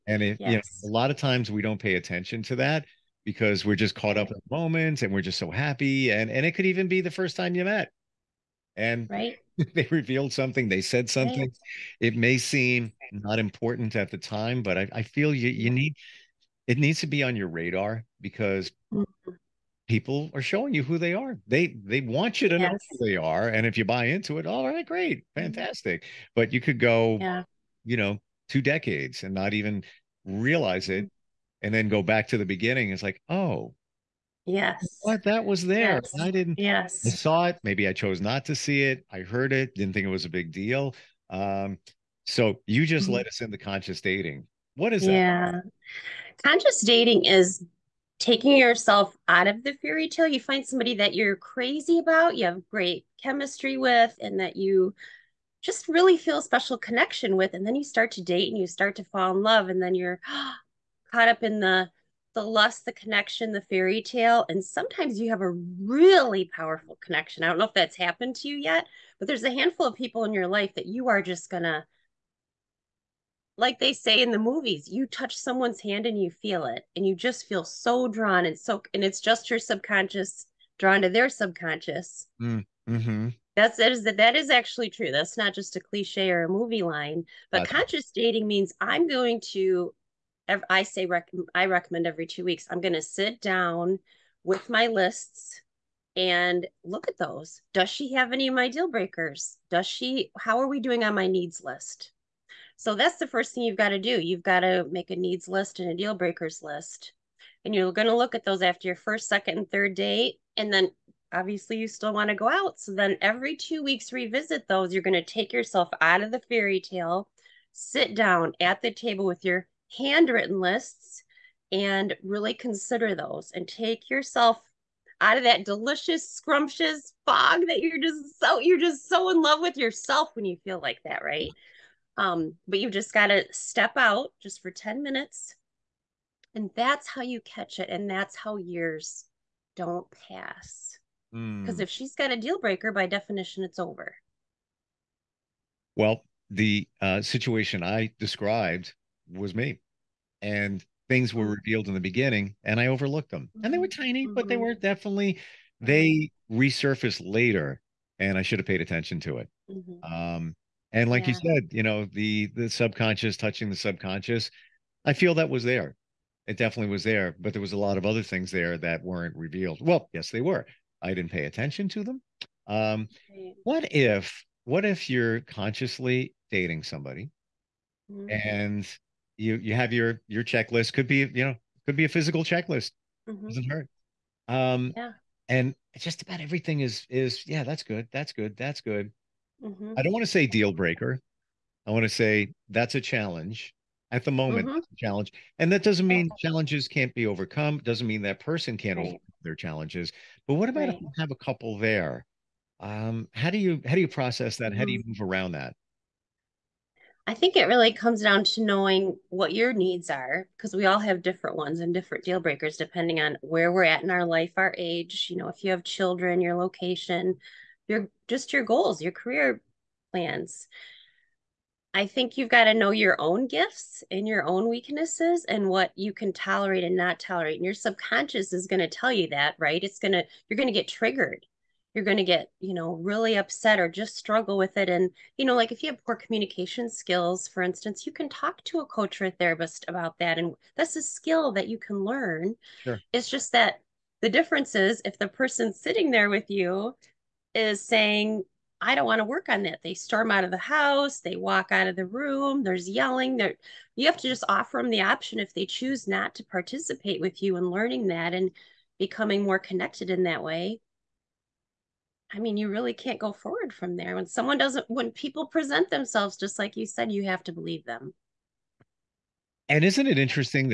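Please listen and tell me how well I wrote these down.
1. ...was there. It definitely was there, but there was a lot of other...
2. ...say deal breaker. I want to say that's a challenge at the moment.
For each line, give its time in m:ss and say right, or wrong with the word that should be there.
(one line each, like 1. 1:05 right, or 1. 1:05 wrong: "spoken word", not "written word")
1. 2:45 right
2. 3:10 right.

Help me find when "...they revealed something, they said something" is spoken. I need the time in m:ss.
0:09.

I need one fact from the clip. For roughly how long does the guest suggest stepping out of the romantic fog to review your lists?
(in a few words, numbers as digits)
10 minutes.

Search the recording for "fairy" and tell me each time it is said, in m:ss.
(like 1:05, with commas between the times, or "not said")
0:49, 1:03, 1:56.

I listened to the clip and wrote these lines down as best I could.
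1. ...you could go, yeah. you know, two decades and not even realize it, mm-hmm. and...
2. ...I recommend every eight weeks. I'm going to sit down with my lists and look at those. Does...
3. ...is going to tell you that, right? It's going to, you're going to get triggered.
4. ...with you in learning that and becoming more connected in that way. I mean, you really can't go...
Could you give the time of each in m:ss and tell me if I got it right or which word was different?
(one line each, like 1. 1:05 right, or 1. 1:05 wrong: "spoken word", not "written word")
1. 0:26 right
2. 1:31 wrong: "two", not "eight"
3. 3:48 right
4. 4:17 right.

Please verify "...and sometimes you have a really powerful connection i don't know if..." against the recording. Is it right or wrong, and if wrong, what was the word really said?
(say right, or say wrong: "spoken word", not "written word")
right.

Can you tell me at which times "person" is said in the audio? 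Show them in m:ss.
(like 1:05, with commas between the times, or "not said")
3:18, 4:05.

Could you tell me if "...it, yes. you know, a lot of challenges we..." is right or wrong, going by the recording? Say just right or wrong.
wrong.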